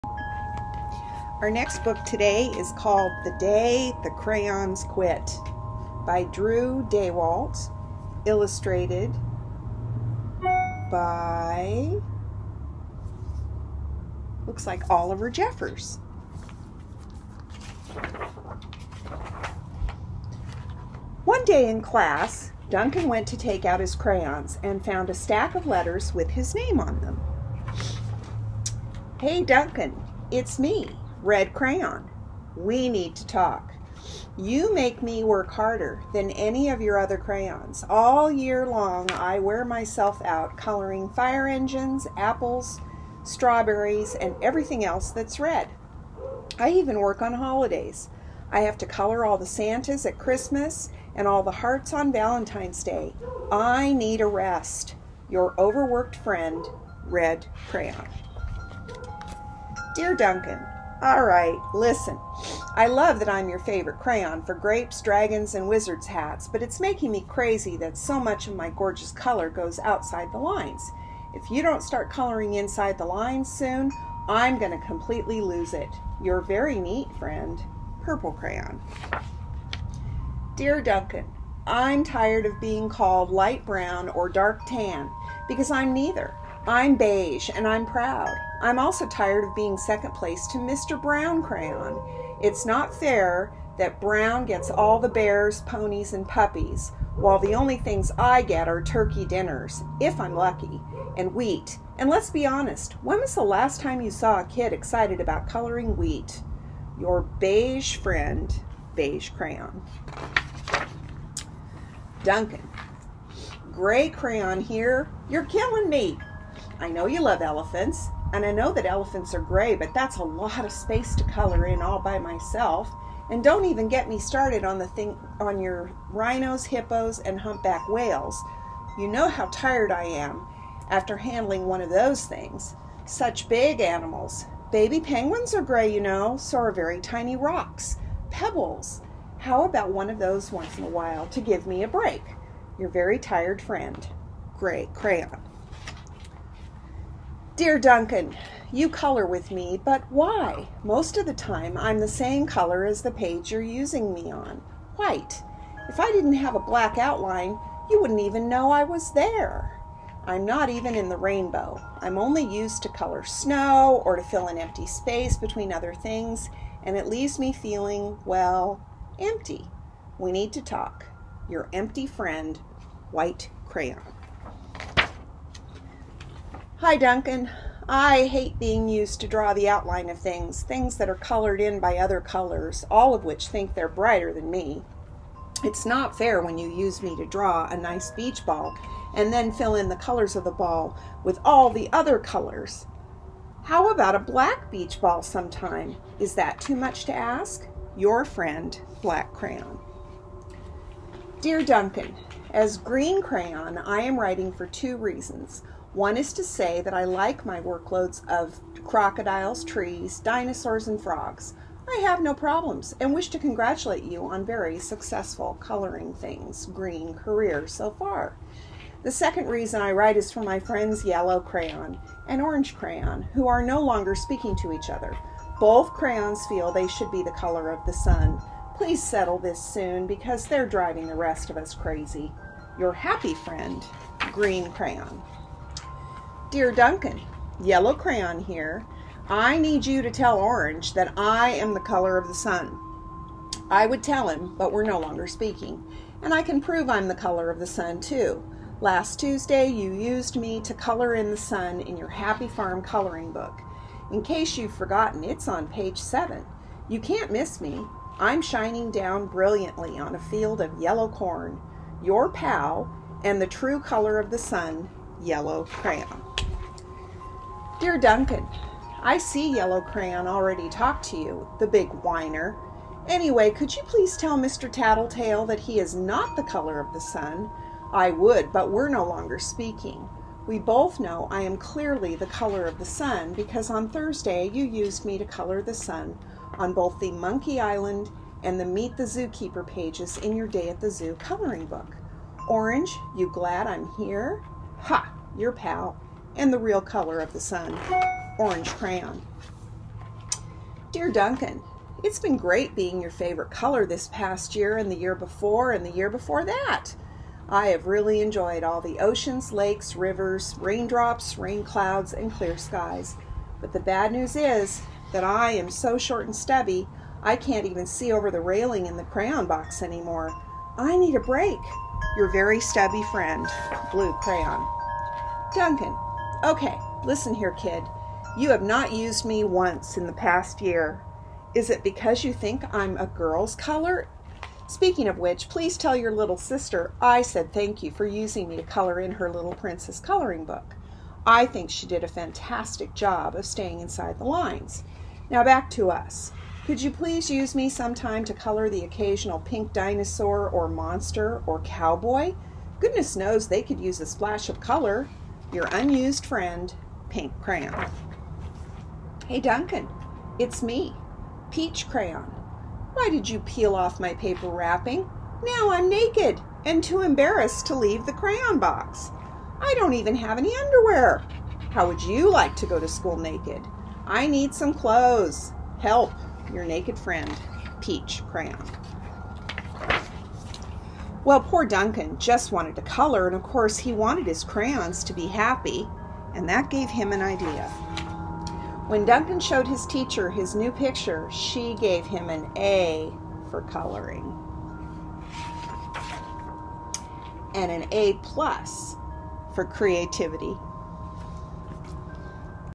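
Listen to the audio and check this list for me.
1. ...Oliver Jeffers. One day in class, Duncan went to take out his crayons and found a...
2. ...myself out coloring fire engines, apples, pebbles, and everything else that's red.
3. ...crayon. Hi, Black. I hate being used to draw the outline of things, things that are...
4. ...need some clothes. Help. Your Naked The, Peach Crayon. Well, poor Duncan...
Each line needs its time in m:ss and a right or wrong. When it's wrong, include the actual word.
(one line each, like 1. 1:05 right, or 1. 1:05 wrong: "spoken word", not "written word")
1. 0:14 right
2. 0:39 wrong: "strawberries", not "pebbles"
3. 2:53 wrong: "Duncan", not "Black"
4. 6:14 wrong: "Friend", not "The".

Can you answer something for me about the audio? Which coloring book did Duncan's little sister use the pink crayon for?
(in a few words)
Little Princess.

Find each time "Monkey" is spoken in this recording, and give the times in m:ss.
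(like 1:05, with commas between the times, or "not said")
4:47.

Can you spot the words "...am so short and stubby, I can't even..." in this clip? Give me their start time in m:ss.
5:15.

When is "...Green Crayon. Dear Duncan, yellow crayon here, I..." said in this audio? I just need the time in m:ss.
3:54.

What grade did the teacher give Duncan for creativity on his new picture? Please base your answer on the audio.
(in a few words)
A plus.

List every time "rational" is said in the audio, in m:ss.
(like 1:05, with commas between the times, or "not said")
not said.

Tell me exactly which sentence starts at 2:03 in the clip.
And don't even get me started on the thing on your rhinos, hippos, and humpback whales.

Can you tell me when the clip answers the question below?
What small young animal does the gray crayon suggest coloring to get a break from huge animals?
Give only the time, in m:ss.
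2:14.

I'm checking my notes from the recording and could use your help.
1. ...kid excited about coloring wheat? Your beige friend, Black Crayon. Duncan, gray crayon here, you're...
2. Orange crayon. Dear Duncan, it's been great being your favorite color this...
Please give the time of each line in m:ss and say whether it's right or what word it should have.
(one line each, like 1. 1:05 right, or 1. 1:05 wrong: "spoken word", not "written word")
1. 1:44 wrong: "Beige", not "Black"
2. 4:58 right.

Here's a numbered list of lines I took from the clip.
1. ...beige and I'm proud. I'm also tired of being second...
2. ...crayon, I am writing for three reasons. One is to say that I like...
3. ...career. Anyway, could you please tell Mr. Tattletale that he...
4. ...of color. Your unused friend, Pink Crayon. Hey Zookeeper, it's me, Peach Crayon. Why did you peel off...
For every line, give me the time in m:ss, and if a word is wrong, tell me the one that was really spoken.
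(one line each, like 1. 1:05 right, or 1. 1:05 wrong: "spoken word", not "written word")
1. 1:26 right
2. 3:23 wrong: "two", not "three"
3. 4:31 wrong: "whiner", not "career"
4. 5:54 wrong: "Duncan", not "Zookeeper".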